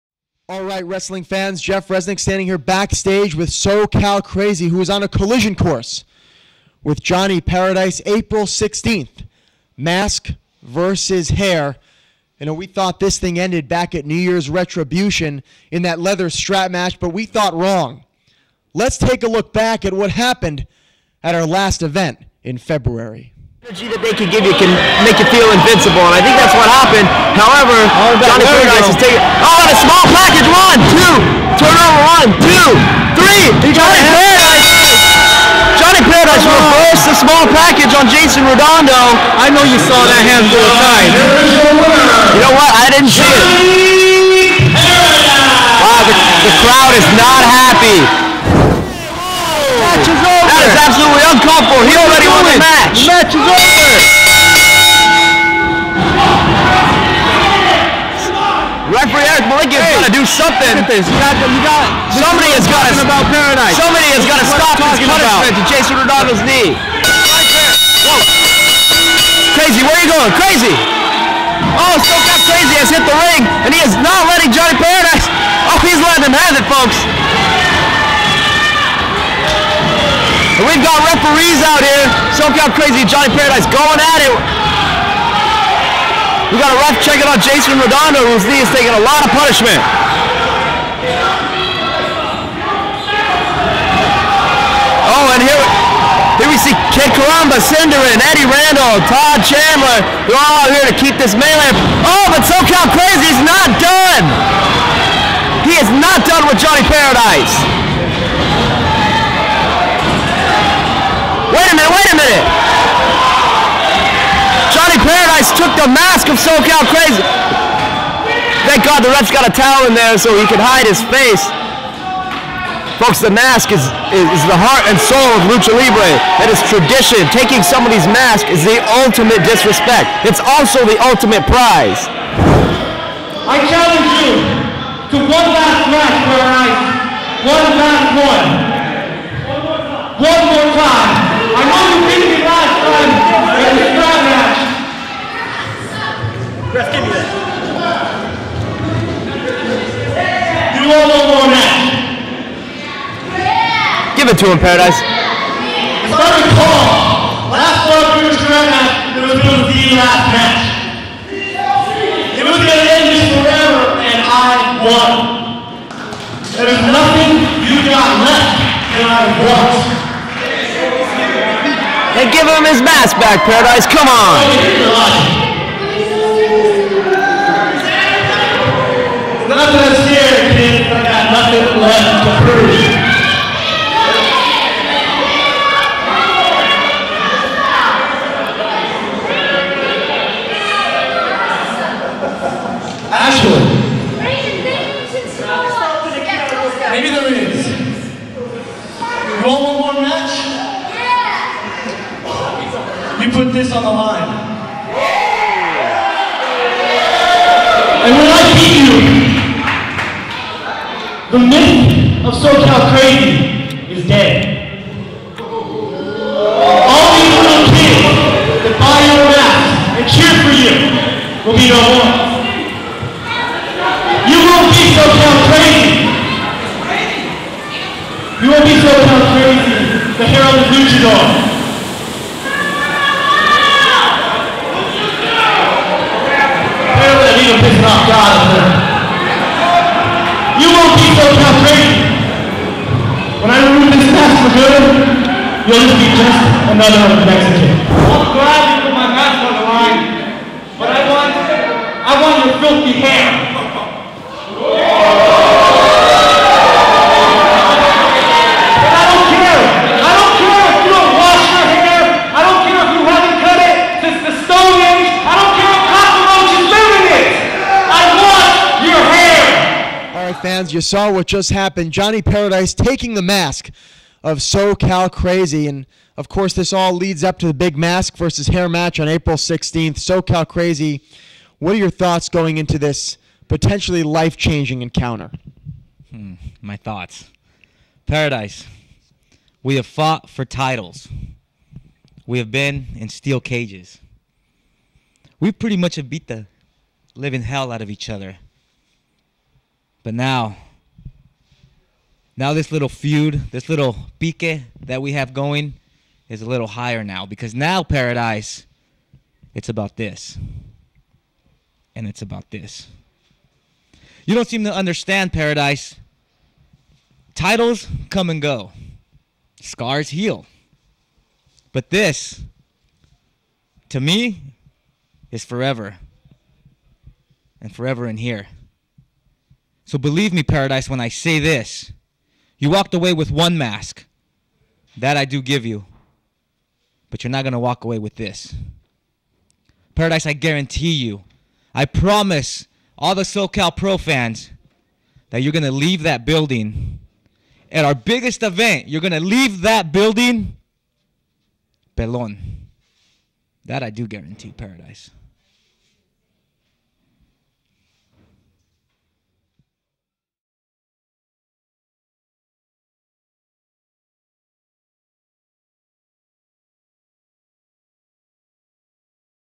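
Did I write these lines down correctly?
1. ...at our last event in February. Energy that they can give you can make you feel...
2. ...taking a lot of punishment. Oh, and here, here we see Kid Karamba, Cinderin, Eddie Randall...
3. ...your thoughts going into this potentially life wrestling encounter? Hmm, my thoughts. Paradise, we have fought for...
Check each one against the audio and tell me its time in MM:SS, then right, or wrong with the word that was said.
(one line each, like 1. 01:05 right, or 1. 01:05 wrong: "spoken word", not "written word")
1. 00:21 right
2. 01:28 right
3. 04:41 wrong: "changing", not "wrestling".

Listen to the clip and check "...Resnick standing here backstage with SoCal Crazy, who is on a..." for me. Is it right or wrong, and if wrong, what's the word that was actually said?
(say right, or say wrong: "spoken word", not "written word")
right.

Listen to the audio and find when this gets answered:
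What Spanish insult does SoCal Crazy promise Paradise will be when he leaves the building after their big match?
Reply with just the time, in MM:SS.
05:51.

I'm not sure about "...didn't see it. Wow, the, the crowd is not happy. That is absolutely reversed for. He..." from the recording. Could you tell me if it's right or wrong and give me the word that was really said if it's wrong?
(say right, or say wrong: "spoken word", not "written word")
wrong: "uncalled", not "reversed".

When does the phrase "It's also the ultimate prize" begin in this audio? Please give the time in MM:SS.
02:10.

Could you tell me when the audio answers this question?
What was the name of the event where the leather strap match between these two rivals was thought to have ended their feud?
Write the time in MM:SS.
00:14.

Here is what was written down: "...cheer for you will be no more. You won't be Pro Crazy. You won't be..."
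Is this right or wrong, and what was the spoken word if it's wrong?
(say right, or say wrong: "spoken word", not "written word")
wrong: "SoCal", not "Pro".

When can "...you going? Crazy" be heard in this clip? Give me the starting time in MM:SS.
01:10.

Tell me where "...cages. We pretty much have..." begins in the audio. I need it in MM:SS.
04:53.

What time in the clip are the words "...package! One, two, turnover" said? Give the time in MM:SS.
00:30.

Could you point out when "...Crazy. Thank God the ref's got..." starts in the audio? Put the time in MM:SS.
01:56.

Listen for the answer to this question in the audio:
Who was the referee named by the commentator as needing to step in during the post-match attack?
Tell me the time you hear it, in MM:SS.
00:59.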